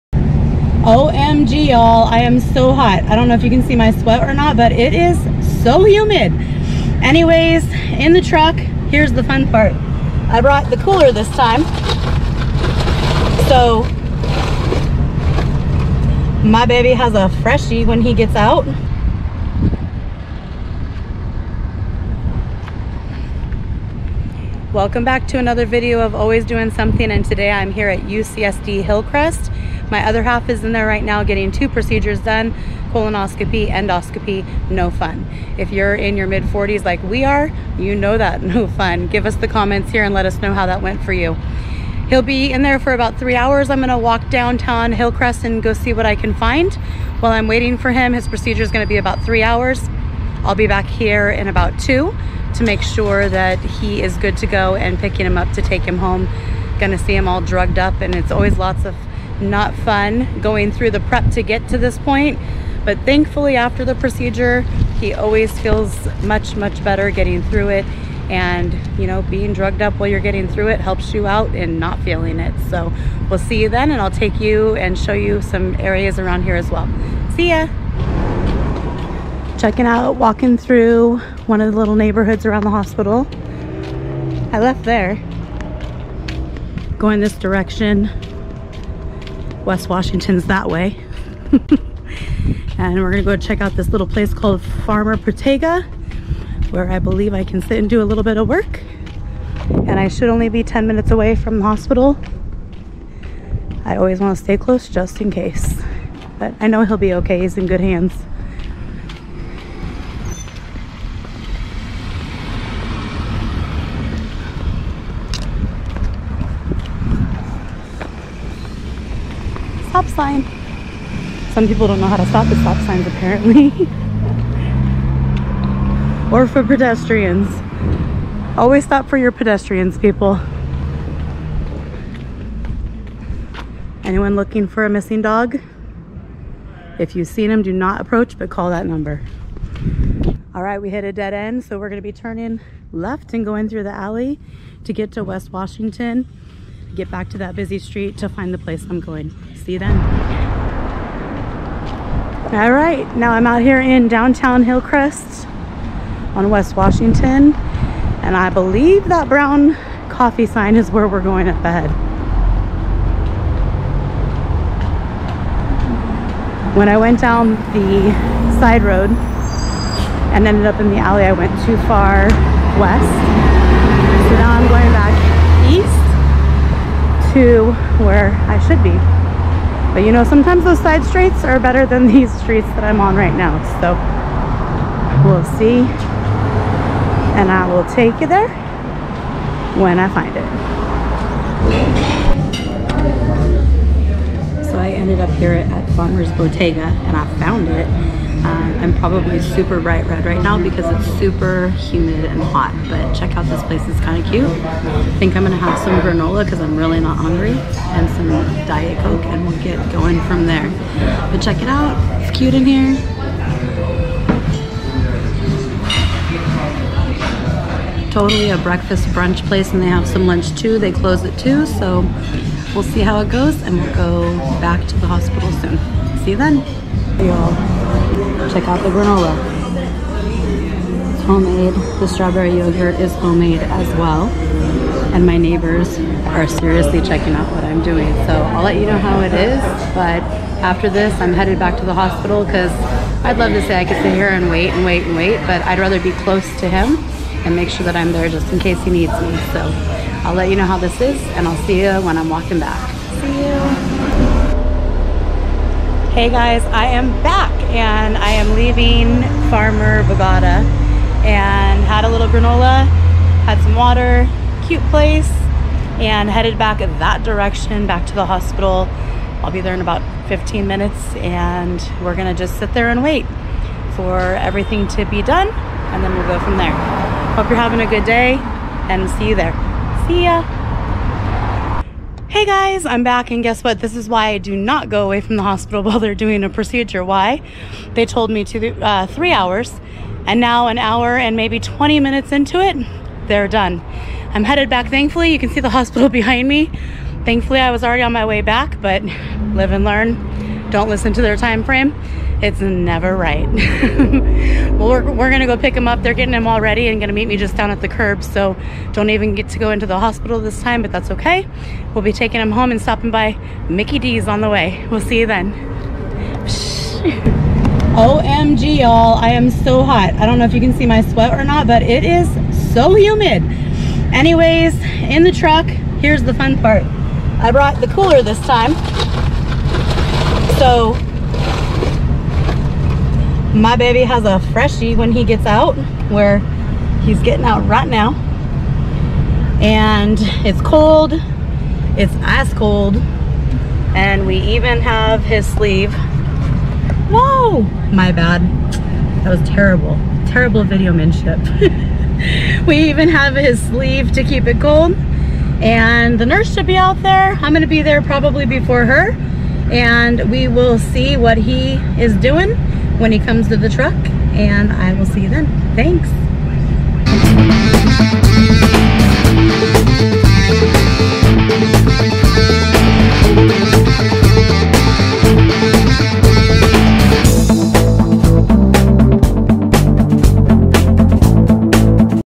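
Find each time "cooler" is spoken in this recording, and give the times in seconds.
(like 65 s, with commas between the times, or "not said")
10 s, 327 s.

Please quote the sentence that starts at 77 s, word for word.
See ya checking out, walking through one of the little neighborhoods around the hospital.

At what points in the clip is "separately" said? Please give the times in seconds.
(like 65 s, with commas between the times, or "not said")
not said.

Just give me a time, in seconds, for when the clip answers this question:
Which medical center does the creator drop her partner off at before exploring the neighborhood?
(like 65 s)
27 s.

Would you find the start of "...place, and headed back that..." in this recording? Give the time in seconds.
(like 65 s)
264 s.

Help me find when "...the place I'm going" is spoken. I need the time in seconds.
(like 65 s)
148 s.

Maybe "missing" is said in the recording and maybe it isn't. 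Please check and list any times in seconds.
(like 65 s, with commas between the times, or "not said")
134 s.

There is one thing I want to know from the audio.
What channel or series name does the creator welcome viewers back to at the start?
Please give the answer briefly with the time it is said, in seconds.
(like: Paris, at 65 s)
Always Doing Something, at 26 s.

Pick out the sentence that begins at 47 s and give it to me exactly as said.
While I'm waiting for him, his procedure is gonna be about three hours.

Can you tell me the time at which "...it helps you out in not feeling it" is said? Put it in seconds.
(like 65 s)
70 s.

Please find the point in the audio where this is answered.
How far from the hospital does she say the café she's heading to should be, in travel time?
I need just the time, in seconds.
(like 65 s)
100 s.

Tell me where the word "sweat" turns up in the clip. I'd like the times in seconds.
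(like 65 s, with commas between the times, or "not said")
3 s, 321 s.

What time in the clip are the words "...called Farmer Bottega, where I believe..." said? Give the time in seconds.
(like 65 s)
94 s.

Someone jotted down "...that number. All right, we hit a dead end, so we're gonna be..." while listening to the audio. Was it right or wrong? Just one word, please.
right.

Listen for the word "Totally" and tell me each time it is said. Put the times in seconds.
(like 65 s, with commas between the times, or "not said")
218 s.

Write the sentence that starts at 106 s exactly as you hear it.
But I know he'll be okay, he's in good hands.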